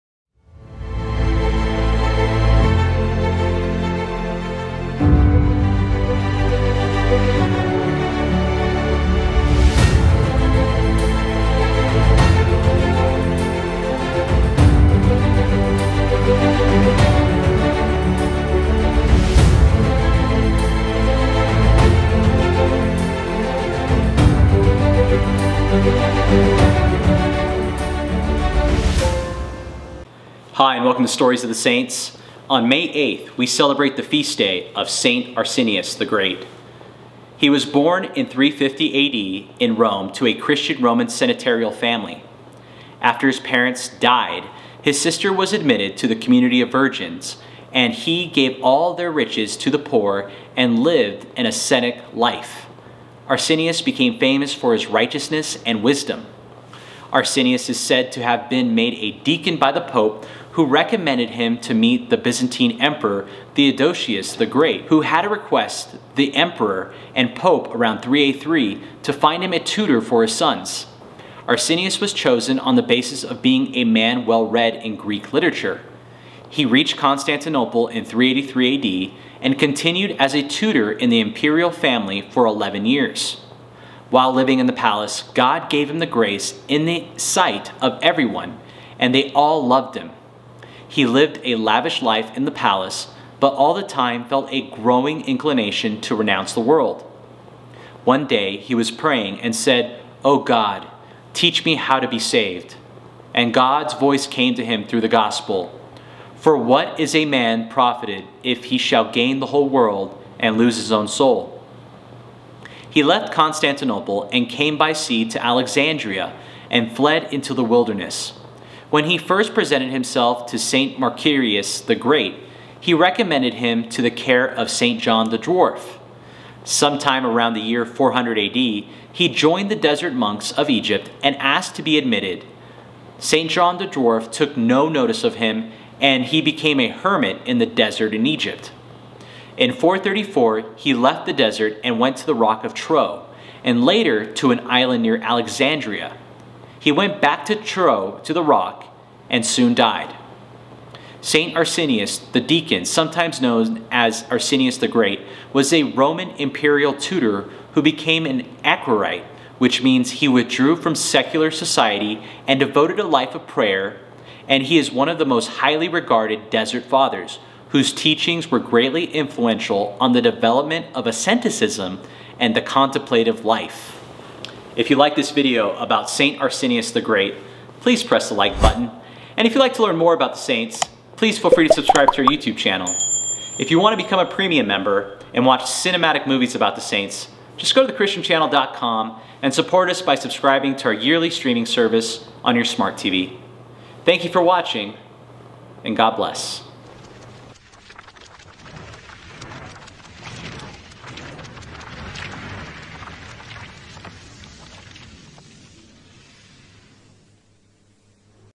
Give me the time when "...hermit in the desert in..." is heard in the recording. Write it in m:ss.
2:16.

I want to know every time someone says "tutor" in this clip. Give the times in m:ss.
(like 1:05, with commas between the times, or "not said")
1:09, 1:20, 2:36.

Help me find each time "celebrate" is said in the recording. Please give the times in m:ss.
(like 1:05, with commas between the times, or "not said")
0:33.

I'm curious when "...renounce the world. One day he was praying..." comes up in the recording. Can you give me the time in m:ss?
1:36.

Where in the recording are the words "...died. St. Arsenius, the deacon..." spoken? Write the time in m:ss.
2:29.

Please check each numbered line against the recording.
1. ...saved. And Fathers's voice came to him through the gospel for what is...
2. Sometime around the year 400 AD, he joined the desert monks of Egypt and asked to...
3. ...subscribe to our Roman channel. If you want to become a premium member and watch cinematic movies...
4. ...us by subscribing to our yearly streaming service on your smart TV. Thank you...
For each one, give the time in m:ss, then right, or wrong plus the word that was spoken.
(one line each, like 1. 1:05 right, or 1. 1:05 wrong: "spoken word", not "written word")
1. 1:42 wrong: "God", not "Fathers"
2. 2:06 right
3. 3:01 wrong: "YouTube", not "Roman"
4. 3:09 right.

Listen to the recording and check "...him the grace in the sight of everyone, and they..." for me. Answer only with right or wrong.
right.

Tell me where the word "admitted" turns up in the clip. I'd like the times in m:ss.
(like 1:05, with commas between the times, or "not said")
0:45, 2:11.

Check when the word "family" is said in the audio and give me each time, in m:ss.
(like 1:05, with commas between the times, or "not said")
0:41, 1:21.